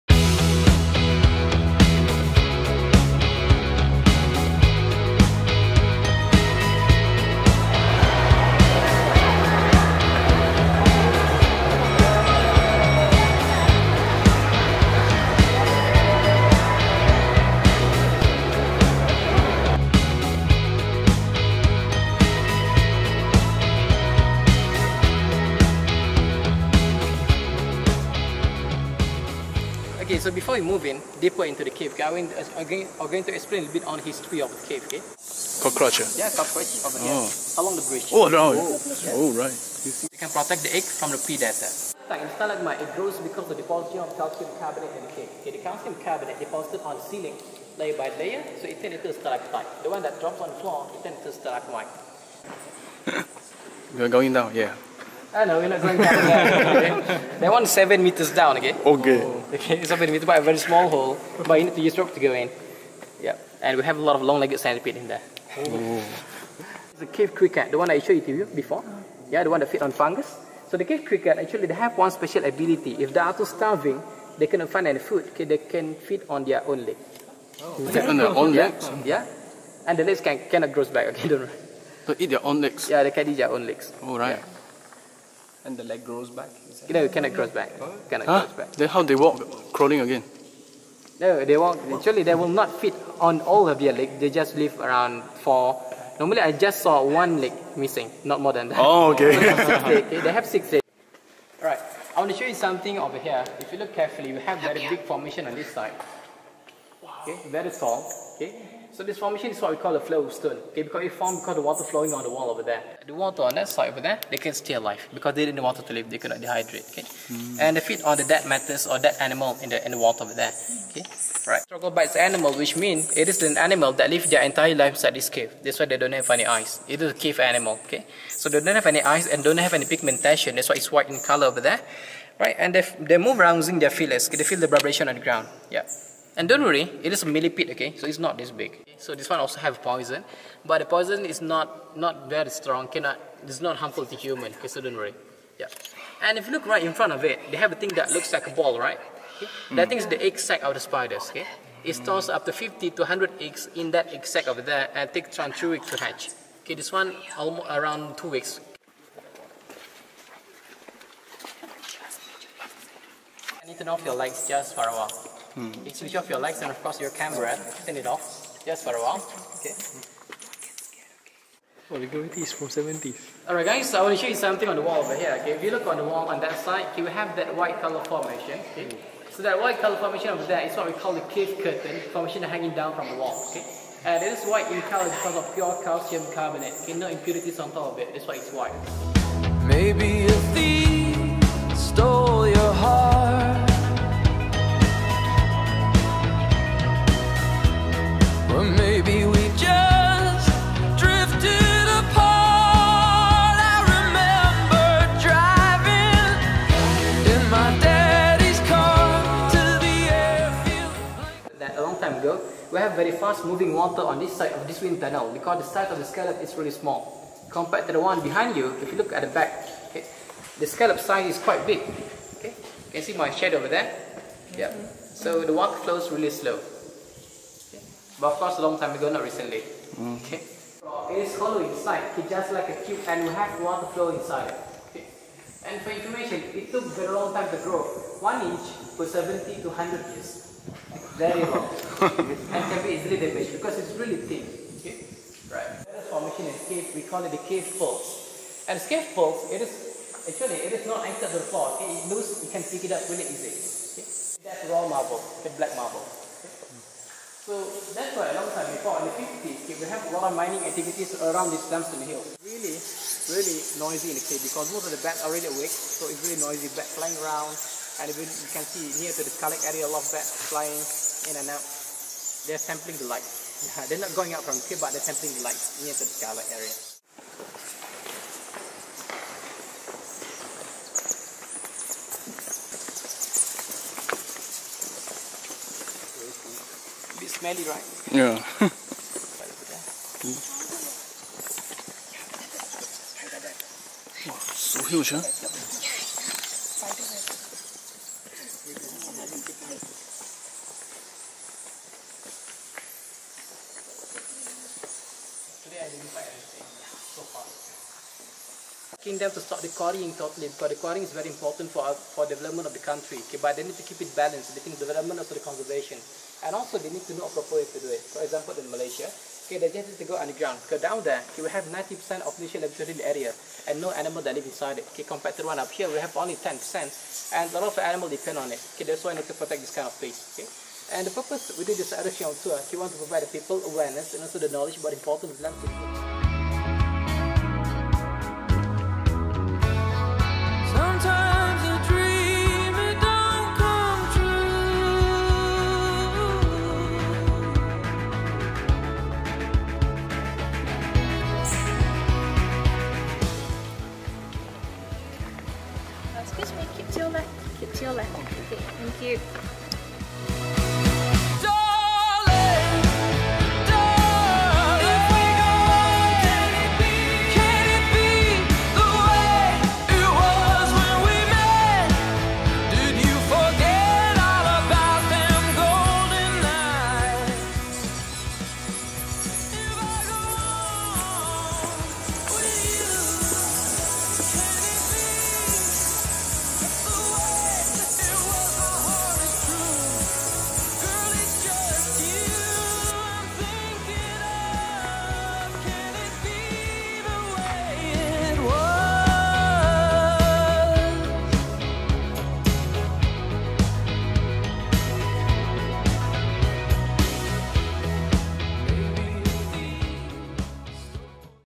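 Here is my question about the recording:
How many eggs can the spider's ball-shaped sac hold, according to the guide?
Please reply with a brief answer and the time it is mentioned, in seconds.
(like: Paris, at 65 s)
50 to 100, at 152 s.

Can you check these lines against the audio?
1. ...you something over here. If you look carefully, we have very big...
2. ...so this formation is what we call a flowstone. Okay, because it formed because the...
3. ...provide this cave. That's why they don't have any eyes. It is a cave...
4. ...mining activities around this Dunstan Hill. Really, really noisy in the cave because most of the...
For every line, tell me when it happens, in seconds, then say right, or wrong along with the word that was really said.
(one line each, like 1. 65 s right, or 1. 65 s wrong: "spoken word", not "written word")
1. 102 s right
2. 108 s right
3. 124 s wrong: "inside", not "provide"
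4. 260 s right.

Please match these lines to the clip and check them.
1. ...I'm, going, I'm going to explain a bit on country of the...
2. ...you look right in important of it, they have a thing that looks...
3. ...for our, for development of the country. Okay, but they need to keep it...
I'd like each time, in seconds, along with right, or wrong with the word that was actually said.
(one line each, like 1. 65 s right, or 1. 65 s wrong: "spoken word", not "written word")
1. 32 s wrong: "history", not "country"
2. 146 s wrong: "front", not "important"
3. 311 s right.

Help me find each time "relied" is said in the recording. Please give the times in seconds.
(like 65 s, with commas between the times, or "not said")
not said.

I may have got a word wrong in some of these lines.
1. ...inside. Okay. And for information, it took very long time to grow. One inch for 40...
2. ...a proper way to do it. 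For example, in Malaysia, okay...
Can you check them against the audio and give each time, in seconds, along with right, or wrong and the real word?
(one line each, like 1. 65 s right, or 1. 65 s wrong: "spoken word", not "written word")
1. 234 s wrong: "70", not "40"
2. 317 s right.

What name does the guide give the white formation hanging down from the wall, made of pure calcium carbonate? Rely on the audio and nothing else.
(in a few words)
cave curtain.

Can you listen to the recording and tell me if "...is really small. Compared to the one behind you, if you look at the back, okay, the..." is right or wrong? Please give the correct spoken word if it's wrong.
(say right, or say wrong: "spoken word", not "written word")
right.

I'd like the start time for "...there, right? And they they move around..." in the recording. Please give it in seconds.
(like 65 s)
131 s.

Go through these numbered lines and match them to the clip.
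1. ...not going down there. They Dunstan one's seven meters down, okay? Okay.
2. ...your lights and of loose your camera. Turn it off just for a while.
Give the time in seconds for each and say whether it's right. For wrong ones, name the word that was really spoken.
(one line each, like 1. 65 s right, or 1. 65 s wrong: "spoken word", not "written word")
1. 55 s wrong: "That", not "Dunstan"
2. 166 s wrong: "course", not "loose".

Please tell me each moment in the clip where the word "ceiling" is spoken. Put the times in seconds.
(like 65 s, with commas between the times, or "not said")
47 s.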